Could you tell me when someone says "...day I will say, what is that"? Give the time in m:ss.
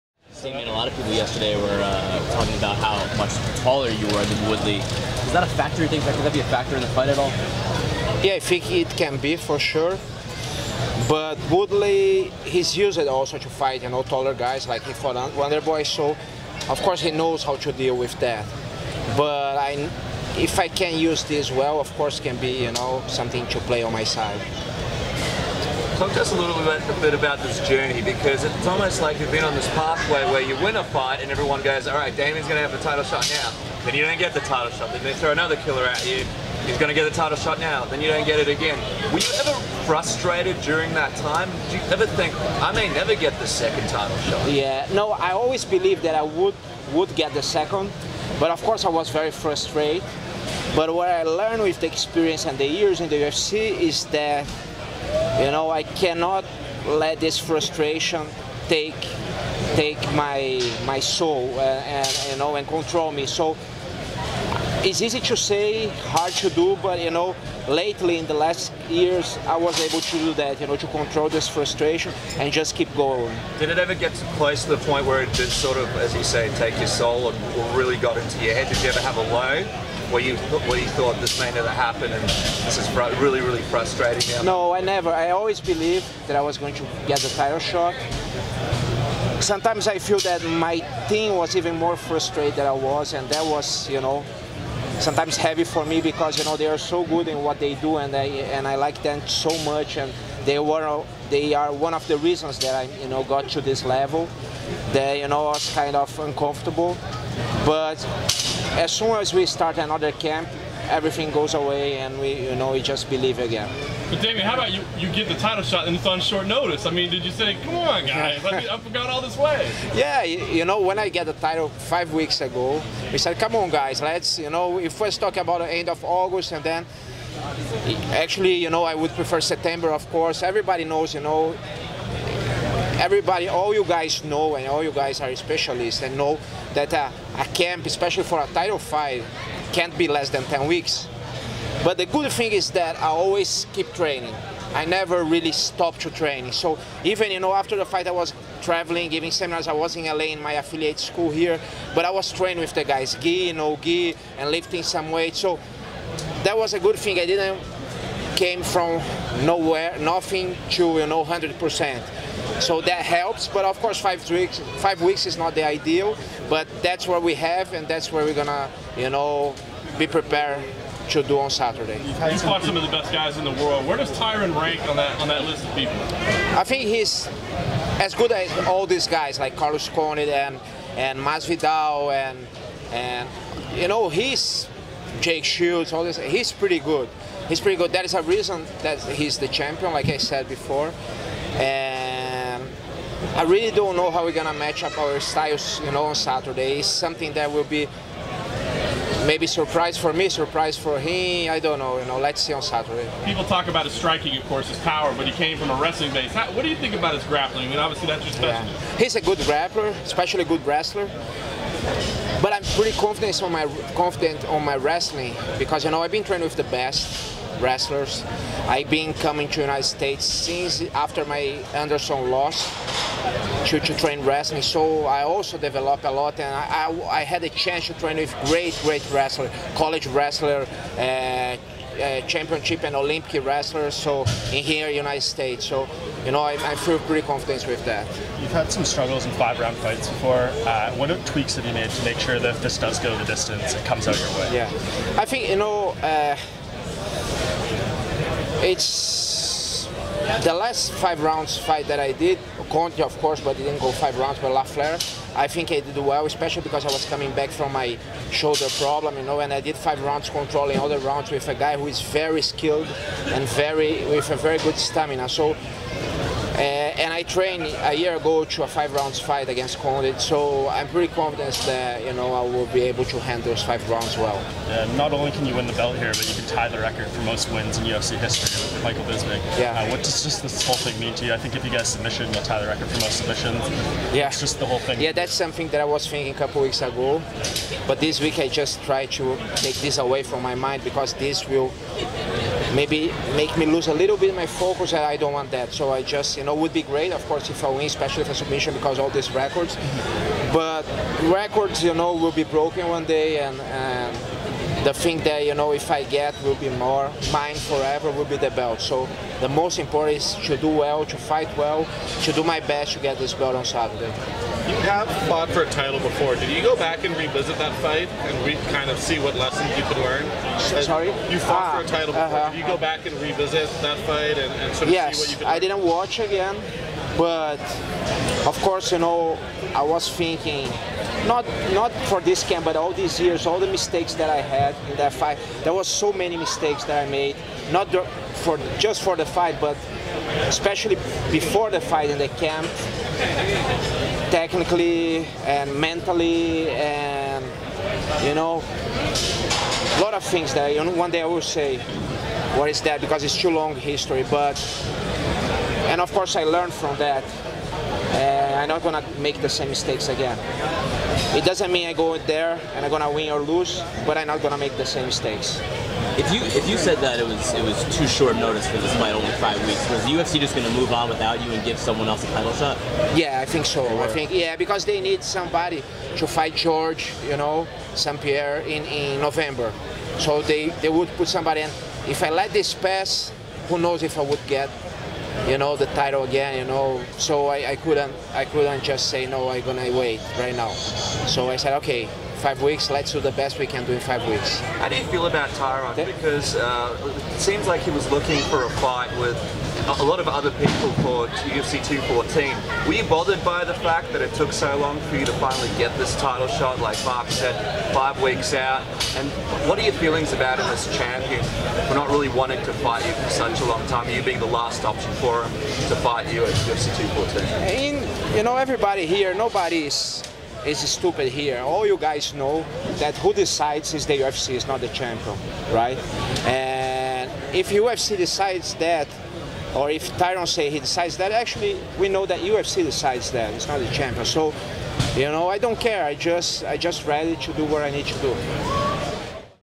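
5:51.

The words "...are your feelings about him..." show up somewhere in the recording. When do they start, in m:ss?
6:49.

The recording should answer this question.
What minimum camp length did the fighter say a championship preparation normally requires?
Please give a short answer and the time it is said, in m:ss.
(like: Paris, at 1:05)
10 weeks, at 2:20.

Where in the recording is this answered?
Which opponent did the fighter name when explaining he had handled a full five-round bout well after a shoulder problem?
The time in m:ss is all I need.
4:14.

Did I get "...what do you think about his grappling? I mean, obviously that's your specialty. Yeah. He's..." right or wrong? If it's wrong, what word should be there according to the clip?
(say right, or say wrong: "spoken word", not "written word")
right.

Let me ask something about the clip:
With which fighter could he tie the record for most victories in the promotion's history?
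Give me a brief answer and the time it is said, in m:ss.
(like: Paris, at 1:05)
Michael Bisping, at 4:38.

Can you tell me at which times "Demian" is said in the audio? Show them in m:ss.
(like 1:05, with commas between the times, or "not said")
0:32, 1:54.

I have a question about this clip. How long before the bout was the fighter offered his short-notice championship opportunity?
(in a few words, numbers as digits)
5 weeks.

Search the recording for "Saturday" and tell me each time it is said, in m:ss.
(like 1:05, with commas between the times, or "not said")
2:51, 3:16, 3:22, 5:13.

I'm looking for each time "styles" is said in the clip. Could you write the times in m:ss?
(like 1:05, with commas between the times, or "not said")
3:15.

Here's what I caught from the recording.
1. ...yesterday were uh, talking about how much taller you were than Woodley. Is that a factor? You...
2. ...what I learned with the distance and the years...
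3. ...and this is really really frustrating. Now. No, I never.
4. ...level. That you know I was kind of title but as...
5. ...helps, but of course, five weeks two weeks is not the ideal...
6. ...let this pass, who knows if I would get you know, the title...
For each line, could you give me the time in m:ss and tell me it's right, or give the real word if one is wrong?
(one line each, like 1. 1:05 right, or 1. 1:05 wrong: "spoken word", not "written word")
1. 0:01 right
2. 0:50 wrong: "experience", not "distance"
3. 1:22 right
4. 1:43 wrong: "uncomfortable", not "title"
5. 2:43 wrong: "five", not "two"
6. 6:22 right.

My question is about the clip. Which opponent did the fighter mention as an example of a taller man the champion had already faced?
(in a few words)
Wonderboy.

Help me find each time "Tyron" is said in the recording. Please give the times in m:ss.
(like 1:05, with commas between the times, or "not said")
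2:54, 6:35, 7:10.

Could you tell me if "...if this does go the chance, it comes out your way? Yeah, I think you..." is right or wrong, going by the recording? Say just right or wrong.
wrong.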